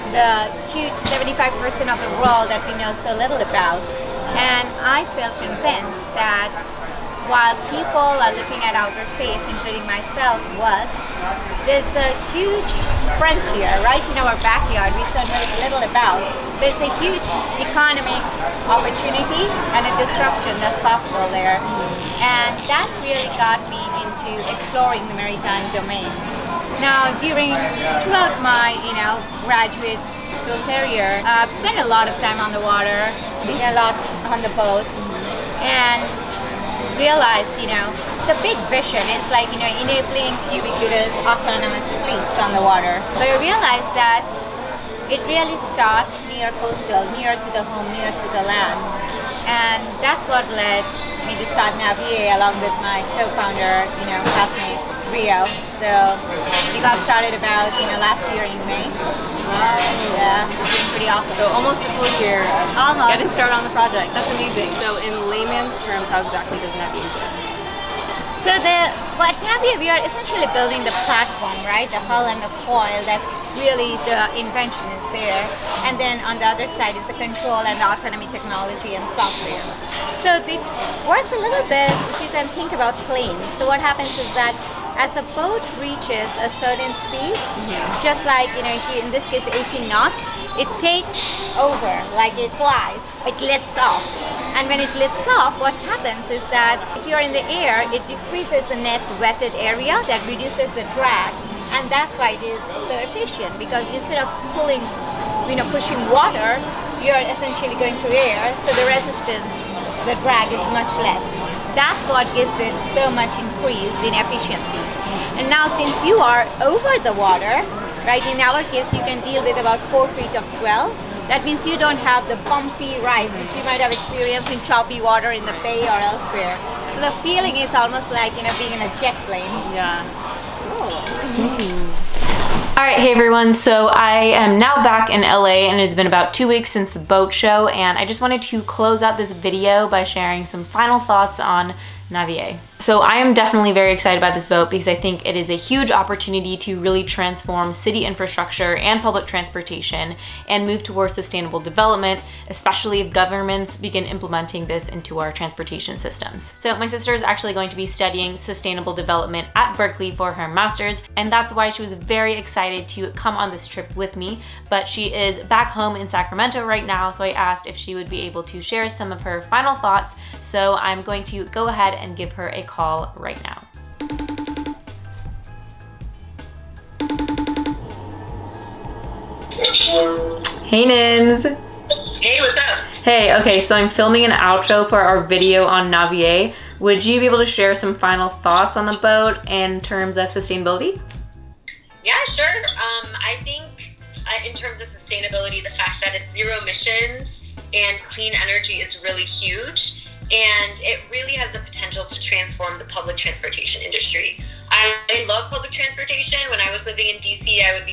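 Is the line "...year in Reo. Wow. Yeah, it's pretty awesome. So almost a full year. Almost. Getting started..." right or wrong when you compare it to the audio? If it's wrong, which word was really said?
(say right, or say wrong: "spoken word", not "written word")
wrong: "May", not "Reo".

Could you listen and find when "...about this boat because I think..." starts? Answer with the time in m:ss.
2:24.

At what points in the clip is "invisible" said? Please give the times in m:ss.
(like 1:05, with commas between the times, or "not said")
not said.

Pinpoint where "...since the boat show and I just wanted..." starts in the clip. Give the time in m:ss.
2:16.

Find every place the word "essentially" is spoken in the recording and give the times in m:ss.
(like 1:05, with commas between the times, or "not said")
1:09, 1:47.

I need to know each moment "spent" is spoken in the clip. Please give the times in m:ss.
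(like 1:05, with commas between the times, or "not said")
0:31.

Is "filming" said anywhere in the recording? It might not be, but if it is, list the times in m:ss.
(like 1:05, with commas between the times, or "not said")
3:03.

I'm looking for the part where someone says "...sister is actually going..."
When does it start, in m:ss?
2:36.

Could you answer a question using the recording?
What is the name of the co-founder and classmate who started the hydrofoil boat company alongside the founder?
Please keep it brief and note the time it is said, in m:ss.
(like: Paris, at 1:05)
Reo, at 0:55.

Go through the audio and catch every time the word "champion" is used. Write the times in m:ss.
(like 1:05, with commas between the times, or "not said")
not said.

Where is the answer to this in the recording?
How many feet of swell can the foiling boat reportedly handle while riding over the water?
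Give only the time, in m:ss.
1:59.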